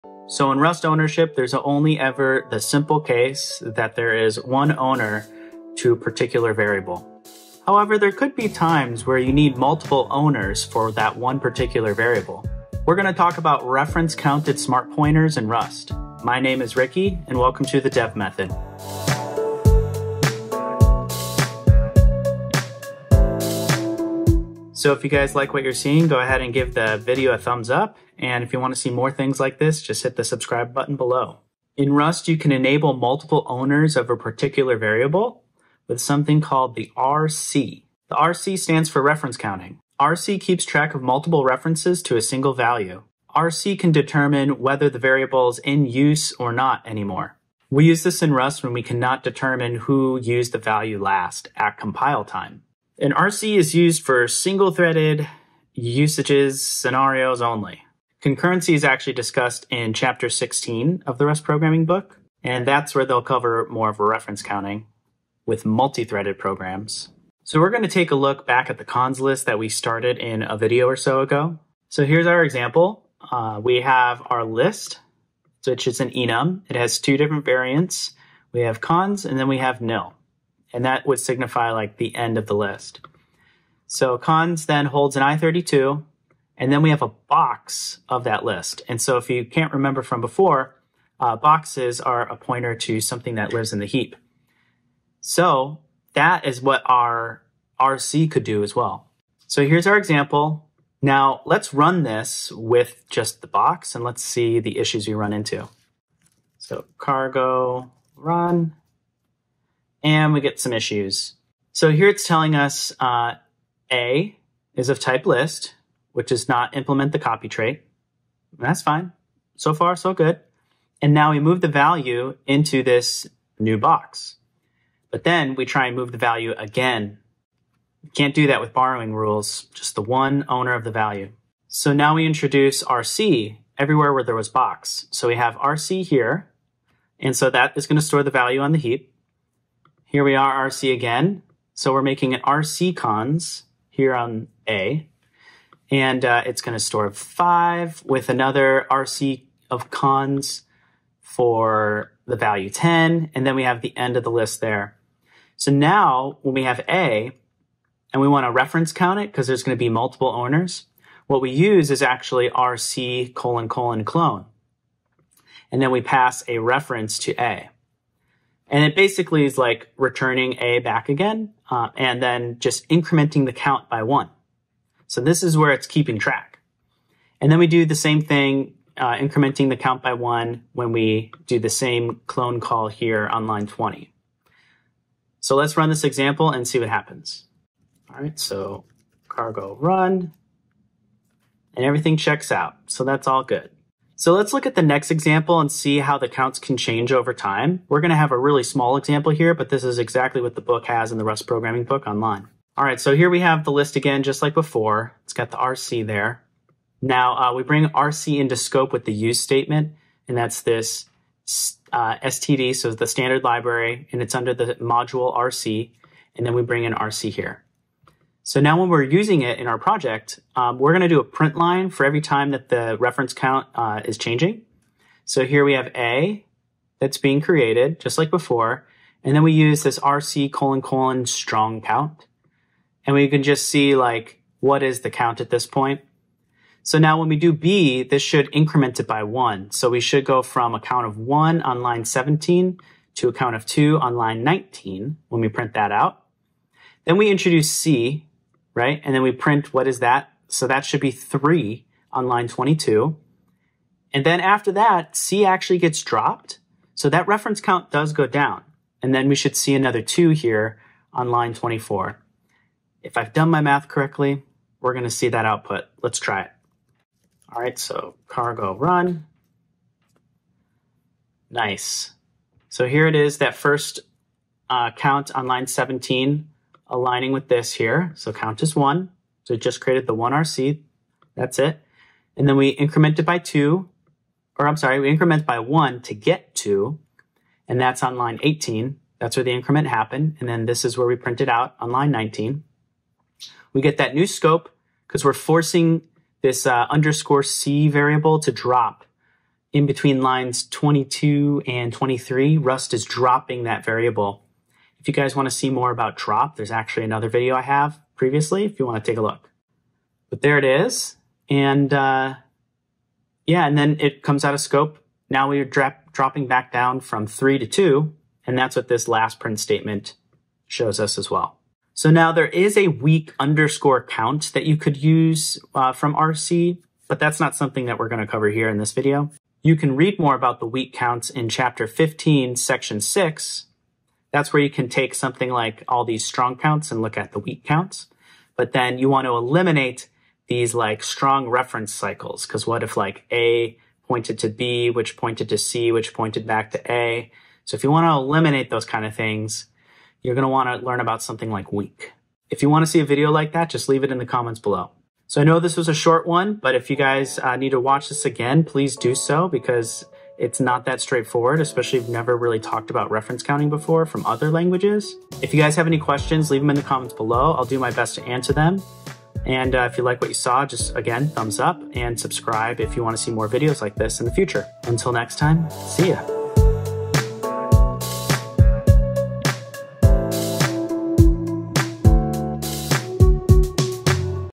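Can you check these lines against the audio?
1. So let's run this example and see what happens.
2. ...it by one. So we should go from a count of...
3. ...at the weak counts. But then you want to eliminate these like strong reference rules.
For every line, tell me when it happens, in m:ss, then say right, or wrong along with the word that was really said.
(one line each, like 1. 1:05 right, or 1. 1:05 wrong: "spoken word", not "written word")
1. 3:05 right
2. 3:58 right
3. 5:37 wrong: "cycles", not "rules".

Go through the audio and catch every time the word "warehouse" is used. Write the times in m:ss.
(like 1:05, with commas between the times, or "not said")
not said.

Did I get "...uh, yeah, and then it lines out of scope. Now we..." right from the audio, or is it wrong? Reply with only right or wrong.
wrong.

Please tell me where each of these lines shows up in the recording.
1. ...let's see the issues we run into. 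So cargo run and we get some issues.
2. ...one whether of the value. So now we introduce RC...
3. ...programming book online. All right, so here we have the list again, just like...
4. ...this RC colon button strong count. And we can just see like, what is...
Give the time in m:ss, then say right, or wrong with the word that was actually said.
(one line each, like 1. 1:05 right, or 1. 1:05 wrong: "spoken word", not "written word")
1. 1:44 right
2. 2:10 wrong: "owner", not "whether"
3. 3:21 right
4. 3:49 wrong: "colon", not "button".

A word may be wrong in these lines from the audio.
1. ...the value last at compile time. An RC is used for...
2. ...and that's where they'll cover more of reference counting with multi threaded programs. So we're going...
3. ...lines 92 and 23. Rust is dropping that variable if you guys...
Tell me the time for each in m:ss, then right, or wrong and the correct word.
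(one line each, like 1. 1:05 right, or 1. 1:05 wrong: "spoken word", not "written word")
1. 0:50 right
2. 1:02 right
3. 5:00 wrong: "22", not "92".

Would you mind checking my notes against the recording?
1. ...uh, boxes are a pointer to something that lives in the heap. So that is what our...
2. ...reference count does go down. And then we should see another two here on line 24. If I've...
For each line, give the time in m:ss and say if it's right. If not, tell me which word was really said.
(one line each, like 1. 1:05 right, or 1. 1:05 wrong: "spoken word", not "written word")
1. 1:31 right
2. 4:17 right.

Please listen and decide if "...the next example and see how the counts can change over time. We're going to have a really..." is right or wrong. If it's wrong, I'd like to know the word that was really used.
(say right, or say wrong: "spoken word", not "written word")
right.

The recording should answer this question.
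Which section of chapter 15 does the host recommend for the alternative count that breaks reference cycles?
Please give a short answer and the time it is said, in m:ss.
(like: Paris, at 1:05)
Section 6, at 5:32.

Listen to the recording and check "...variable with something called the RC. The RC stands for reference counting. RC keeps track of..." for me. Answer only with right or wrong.
right.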